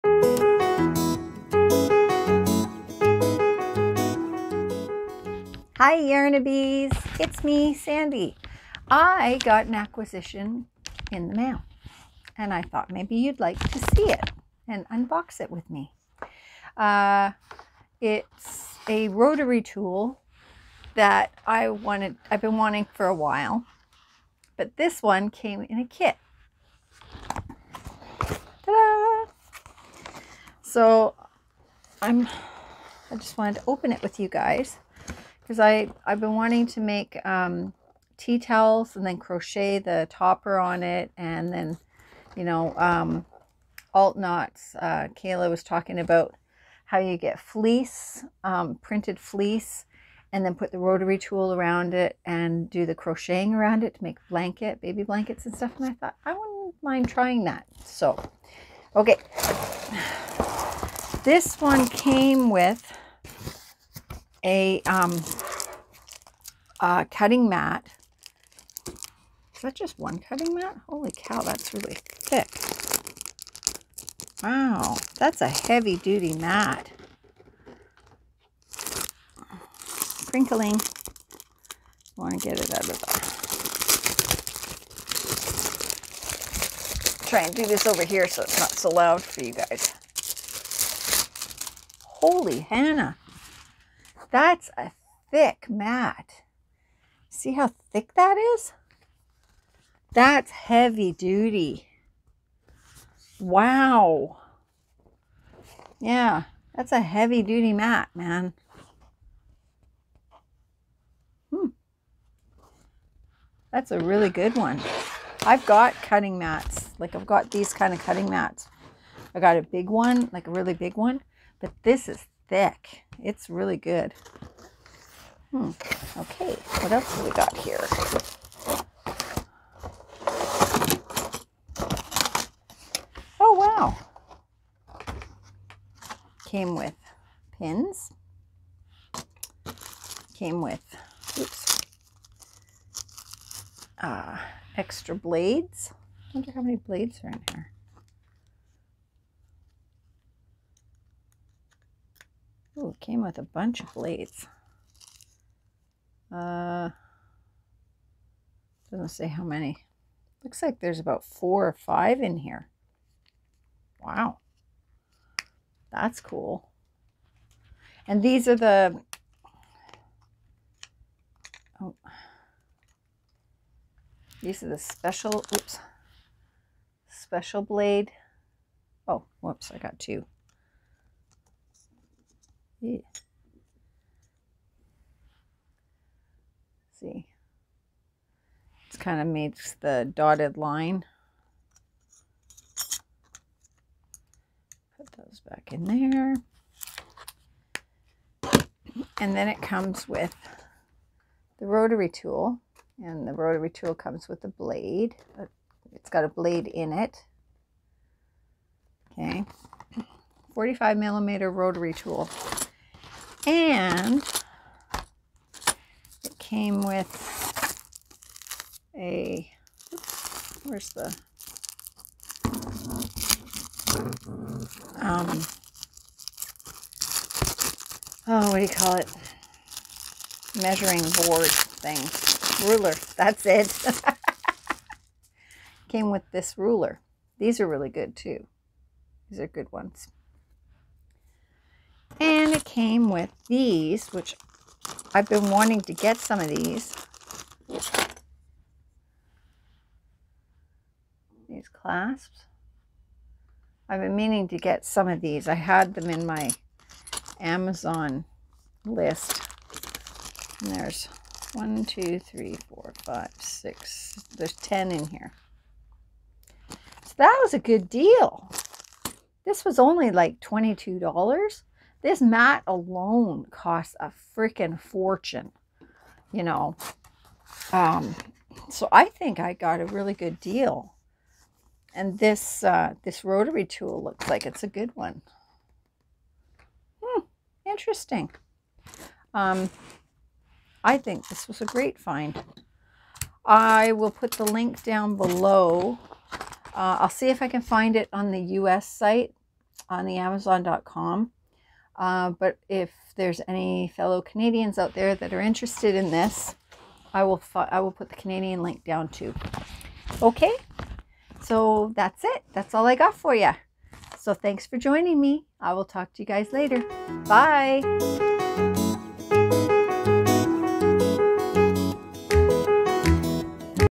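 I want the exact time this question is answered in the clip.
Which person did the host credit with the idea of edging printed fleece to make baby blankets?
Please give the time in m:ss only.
0:45.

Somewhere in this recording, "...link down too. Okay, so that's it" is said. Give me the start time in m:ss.
5:08.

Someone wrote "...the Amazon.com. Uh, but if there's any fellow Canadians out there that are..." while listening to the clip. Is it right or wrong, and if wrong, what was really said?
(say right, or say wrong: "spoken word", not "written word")
right.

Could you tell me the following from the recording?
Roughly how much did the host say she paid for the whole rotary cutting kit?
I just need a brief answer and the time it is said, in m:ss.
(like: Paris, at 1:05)
$22, at 4:30.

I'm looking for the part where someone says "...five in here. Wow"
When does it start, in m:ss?
2:41.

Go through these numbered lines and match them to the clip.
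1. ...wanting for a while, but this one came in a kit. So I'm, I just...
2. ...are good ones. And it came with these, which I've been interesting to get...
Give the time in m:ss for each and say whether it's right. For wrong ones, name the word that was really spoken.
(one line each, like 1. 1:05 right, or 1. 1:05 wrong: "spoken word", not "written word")
1. 0:22 right
2. 3:59 wrong: "wanting", not "interesting".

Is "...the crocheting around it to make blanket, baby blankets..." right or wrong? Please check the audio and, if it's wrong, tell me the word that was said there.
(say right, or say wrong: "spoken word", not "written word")
right.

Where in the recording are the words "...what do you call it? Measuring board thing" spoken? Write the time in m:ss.
3:48.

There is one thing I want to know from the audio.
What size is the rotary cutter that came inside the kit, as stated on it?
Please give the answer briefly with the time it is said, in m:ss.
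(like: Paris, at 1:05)
45 millimeter, at 3:30.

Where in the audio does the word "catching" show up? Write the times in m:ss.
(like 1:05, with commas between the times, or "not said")
not said.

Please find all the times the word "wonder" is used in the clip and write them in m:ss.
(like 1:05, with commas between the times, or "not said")
2:26.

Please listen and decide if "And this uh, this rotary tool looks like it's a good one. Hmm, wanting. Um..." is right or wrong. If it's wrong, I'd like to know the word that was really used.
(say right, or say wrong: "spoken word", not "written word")
wrong: "interesting", not "wanting".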